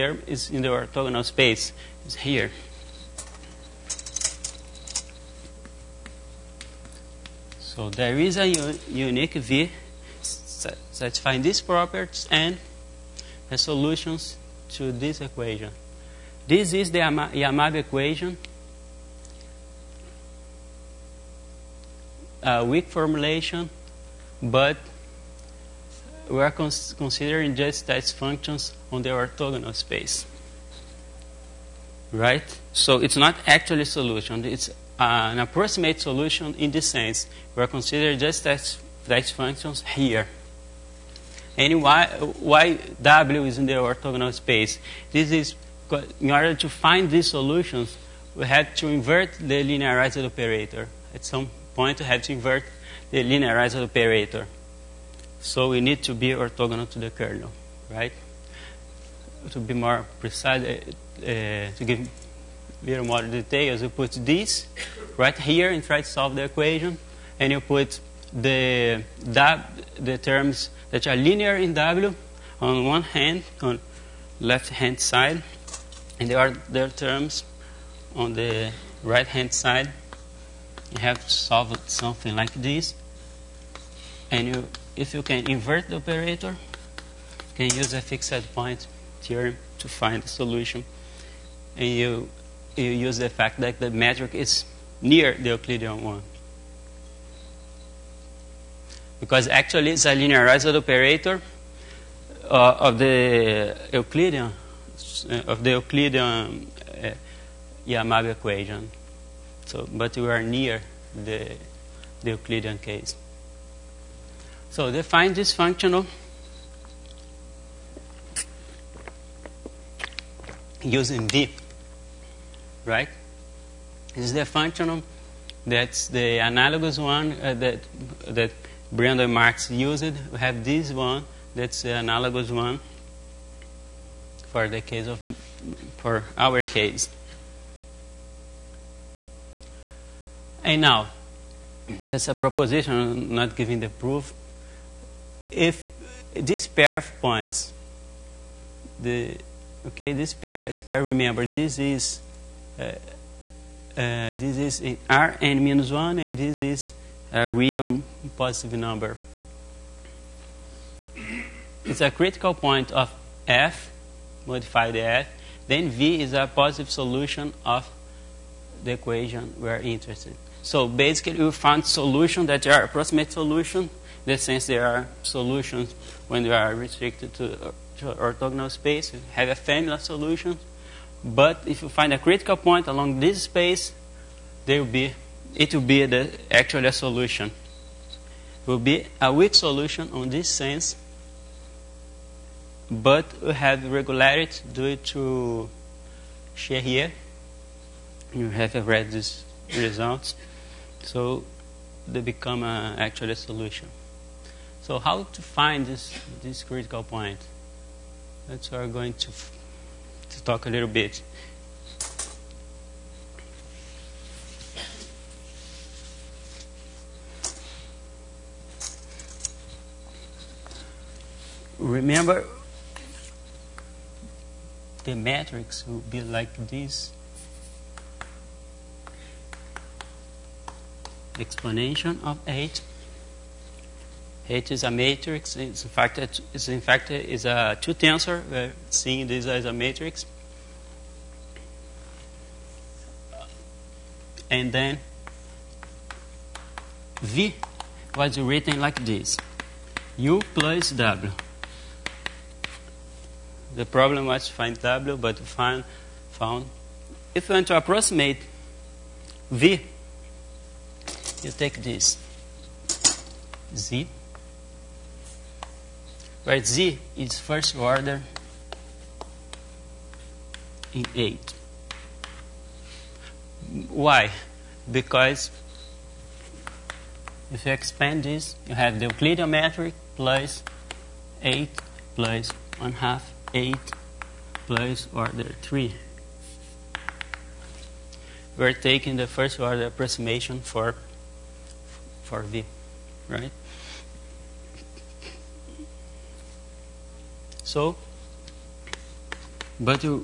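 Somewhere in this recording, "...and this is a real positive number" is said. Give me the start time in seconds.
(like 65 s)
156 s.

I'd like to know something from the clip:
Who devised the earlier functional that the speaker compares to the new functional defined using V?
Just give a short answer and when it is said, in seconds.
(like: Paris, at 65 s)
Brandon Marques, at 128 s.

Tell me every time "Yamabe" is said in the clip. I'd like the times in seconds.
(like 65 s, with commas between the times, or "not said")
16 s, 107 s.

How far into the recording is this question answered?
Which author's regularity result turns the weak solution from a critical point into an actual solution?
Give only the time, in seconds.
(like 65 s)
196 s.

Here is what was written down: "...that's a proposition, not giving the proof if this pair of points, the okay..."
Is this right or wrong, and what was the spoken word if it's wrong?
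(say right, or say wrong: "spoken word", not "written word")
right.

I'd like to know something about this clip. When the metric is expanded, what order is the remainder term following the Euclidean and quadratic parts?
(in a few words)
Order 3.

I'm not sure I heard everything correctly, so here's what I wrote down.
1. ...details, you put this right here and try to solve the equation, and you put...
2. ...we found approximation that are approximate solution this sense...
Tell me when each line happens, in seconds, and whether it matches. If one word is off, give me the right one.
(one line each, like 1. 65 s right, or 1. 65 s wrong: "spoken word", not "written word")
1. 63 s right
2. 171 s wrong: "solution", not "approximation".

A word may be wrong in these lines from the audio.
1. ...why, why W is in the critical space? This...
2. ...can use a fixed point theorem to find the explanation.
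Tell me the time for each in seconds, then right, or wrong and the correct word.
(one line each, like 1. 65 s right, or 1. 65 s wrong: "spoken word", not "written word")
1. 41 s wrong: "orthogonal", not "critical"
2. 87 s wrong: "solution", not "explanation".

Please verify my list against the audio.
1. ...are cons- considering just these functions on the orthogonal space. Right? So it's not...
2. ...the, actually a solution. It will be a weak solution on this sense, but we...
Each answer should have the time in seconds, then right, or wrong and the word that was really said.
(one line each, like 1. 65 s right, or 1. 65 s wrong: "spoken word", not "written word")
1. 26 s right
2. 186 s right.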